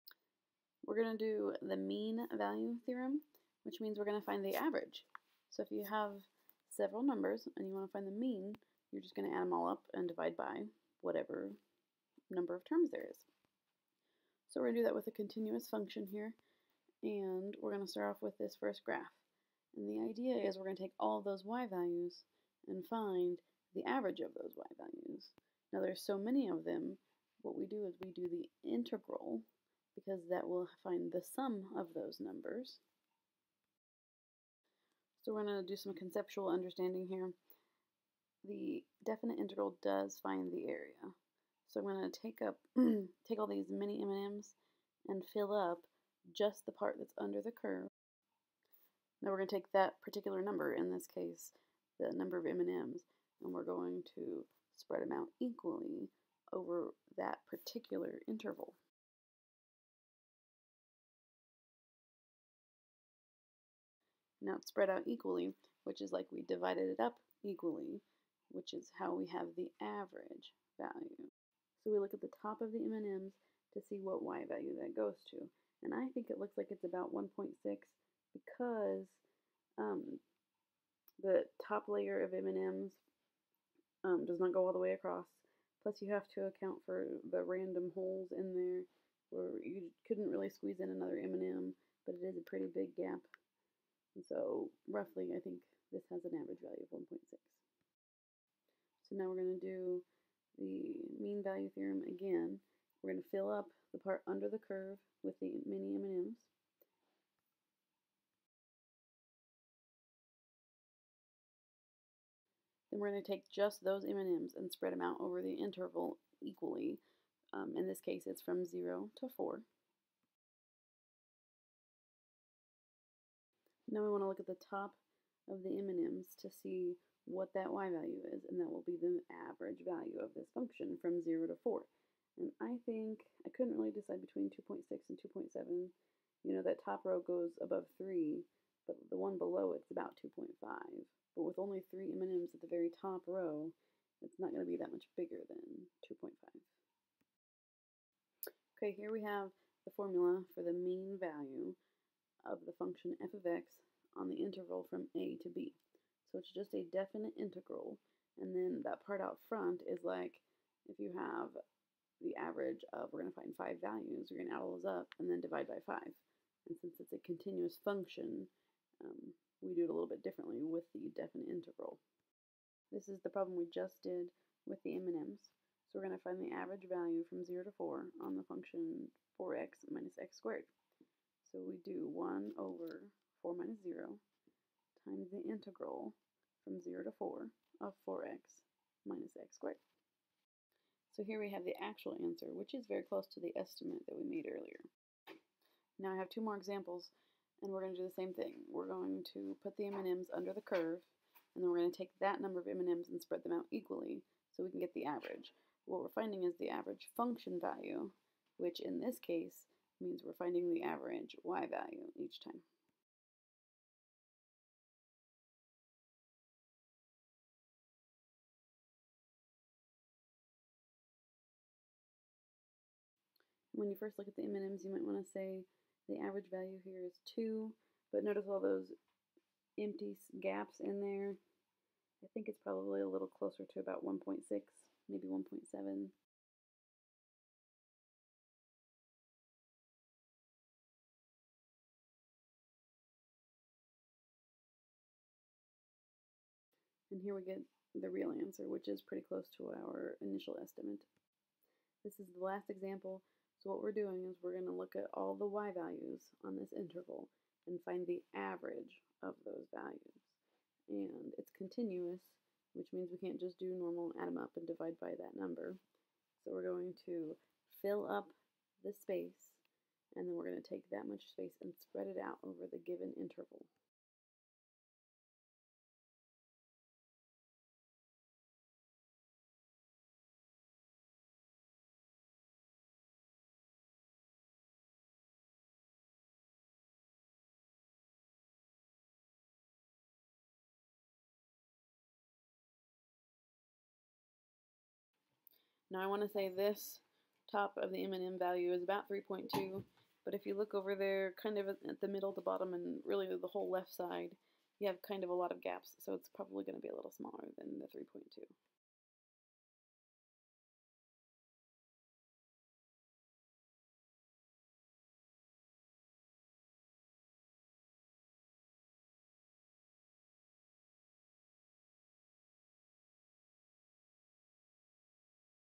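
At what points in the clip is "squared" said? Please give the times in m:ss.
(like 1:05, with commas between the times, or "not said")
3:00, 3:09.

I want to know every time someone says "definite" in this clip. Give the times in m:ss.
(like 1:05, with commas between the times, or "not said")
0:39, 2:36, 2:51.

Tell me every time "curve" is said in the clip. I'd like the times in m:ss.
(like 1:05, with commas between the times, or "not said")
0:47, 1:44, 3:20.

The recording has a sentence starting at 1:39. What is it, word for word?
So now we're going to do the mean value theorem again.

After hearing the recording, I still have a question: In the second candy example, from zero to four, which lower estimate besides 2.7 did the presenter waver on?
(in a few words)
2.6.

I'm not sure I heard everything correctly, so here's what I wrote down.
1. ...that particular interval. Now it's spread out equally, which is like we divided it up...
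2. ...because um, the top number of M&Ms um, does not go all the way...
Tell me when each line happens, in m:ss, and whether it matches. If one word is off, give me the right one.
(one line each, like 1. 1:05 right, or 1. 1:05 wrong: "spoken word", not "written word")
1. 0:57 right
2. 1:18 wrong: "layer", not "number".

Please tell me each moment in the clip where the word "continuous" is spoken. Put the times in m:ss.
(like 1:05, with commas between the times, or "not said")
0:15, 2:47, 4:21.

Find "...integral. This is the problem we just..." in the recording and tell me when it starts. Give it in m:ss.
2:51.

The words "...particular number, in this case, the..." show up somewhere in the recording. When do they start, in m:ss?
0:50.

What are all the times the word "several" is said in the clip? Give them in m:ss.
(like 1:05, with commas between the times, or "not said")
0:06.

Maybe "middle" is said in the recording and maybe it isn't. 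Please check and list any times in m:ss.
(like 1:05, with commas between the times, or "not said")
5:02.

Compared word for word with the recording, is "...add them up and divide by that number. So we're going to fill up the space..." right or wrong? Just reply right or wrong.
right.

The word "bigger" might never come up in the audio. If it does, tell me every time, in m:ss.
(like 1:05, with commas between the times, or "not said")
2:25.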